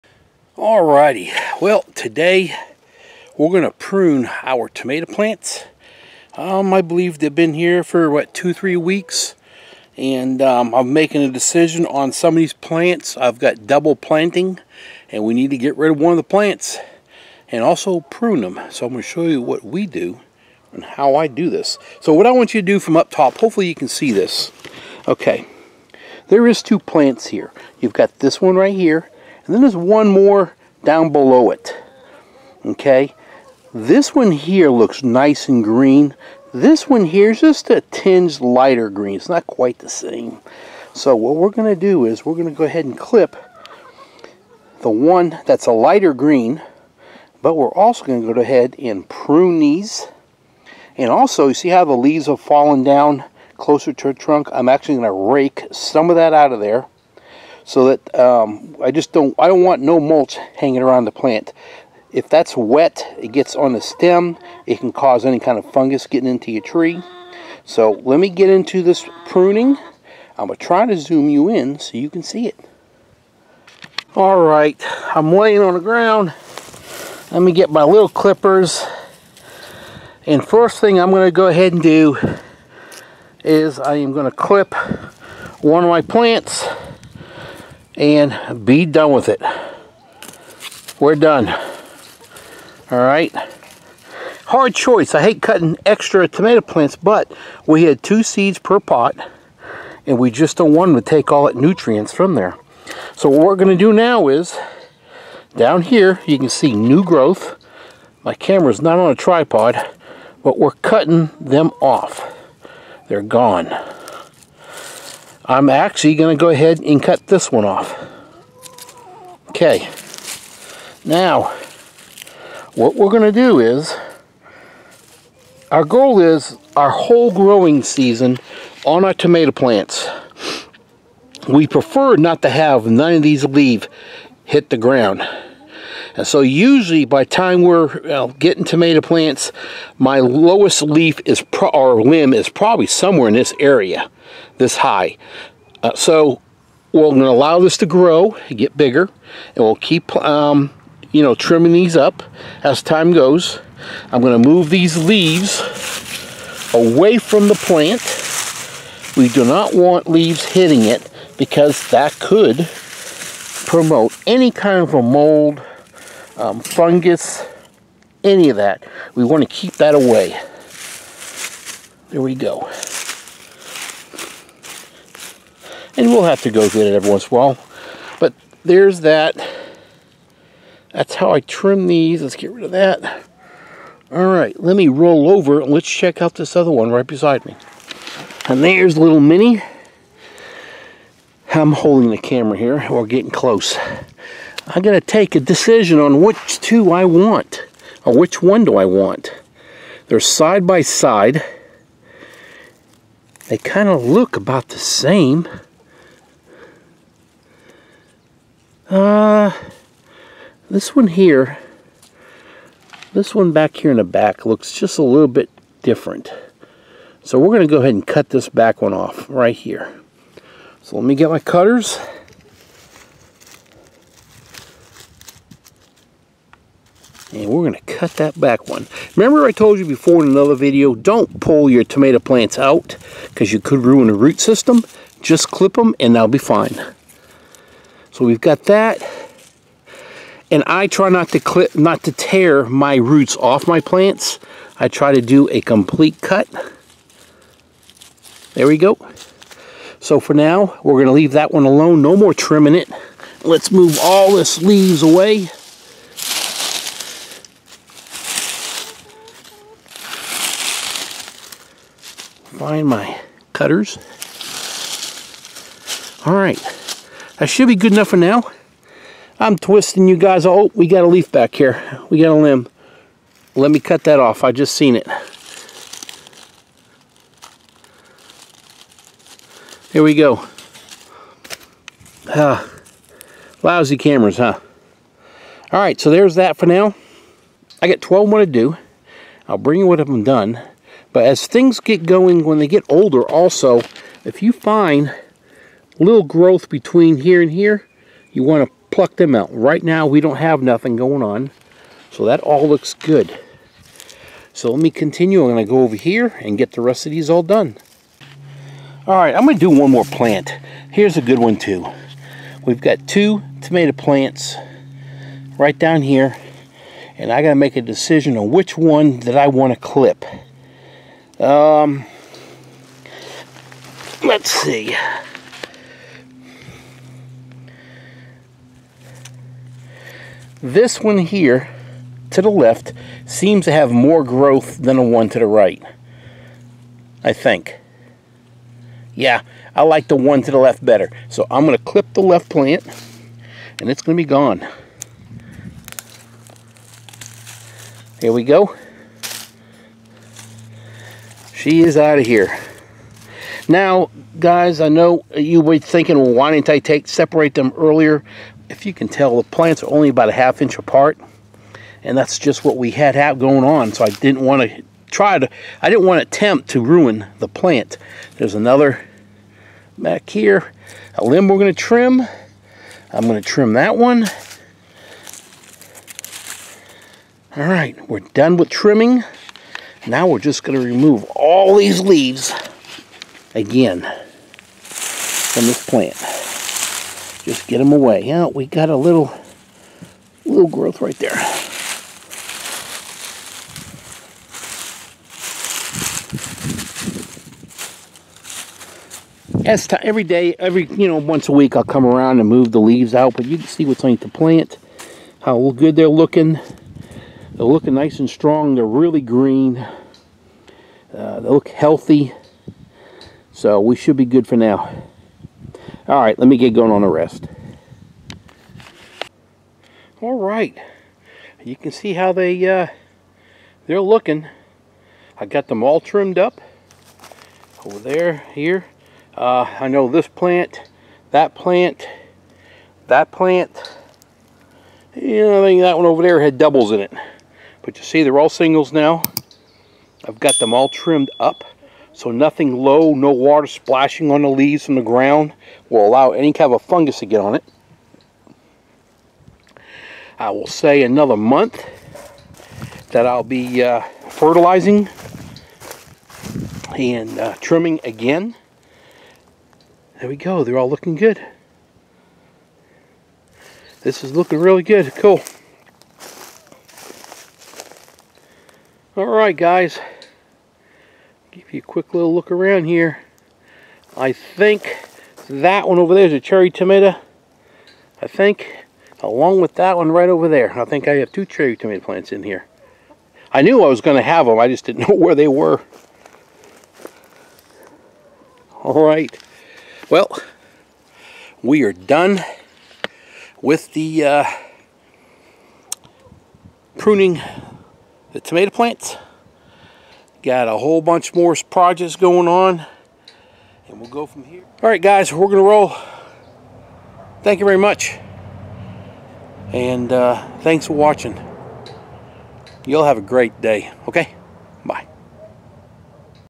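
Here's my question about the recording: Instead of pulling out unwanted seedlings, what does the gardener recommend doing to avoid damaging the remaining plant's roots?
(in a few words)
Clip them.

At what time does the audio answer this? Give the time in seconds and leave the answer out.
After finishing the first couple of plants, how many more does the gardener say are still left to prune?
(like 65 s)
288 s.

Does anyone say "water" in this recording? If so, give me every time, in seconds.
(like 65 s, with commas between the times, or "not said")
443 s.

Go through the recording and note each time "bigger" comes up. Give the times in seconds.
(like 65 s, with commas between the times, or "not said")
148 s.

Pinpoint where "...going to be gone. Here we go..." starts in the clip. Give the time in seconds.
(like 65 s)
344 s.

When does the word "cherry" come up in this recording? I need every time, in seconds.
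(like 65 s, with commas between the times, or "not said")
476 s, 481 s.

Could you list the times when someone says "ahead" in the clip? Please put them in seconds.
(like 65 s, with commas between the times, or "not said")
42 s, 48 s, 81 s, 116 s, 217 s.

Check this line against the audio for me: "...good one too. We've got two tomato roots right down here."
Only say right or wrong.
wrong.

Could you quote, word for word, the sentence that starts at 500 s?
Got a whole bunch more projects going on.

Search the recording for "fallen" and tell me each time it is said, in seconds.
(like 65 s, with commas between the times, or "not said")
52 s.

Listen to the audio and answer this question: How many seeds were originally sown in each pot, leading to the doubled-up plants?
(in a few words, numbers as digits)
2.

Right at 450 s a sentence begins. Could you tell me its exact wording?
I will say another month that I'll be uh, fertilizing and uh, trimming again.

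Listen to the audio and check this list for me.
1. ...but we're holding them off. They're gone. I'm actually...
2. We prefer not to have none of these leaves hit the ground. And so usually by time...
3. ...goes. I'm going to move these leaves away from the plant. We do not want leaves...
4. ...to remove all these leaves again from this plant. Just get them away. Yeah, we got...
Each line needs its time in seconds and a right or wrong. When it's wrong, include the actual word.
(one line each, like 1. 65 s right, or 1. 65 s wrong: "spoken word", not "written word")
1. 110 s wrong: "cutting", not "holding"
2. 131 s right
3. 153 s right
4. 380 s right.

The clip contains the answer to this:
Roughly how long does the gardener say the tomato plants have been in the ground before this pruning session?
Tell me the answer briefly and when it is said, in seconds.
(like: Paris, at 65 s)
2-3 weeks, at 8 s.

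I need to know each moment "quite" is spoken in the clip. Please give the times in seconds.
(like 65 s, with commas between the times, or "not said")
39 s.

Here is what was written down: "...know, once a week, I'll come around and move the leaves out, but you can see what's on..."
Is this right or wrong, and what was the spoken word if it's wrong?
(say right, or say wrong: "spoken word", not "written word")
right.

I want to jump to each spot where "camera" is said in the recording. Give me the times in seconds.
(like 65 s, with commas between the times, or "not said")
108 s, 192 s, 283 s.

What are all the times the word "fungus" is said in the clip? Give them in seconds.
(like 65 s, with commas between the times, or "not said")
65 s, 166 s, 446 s.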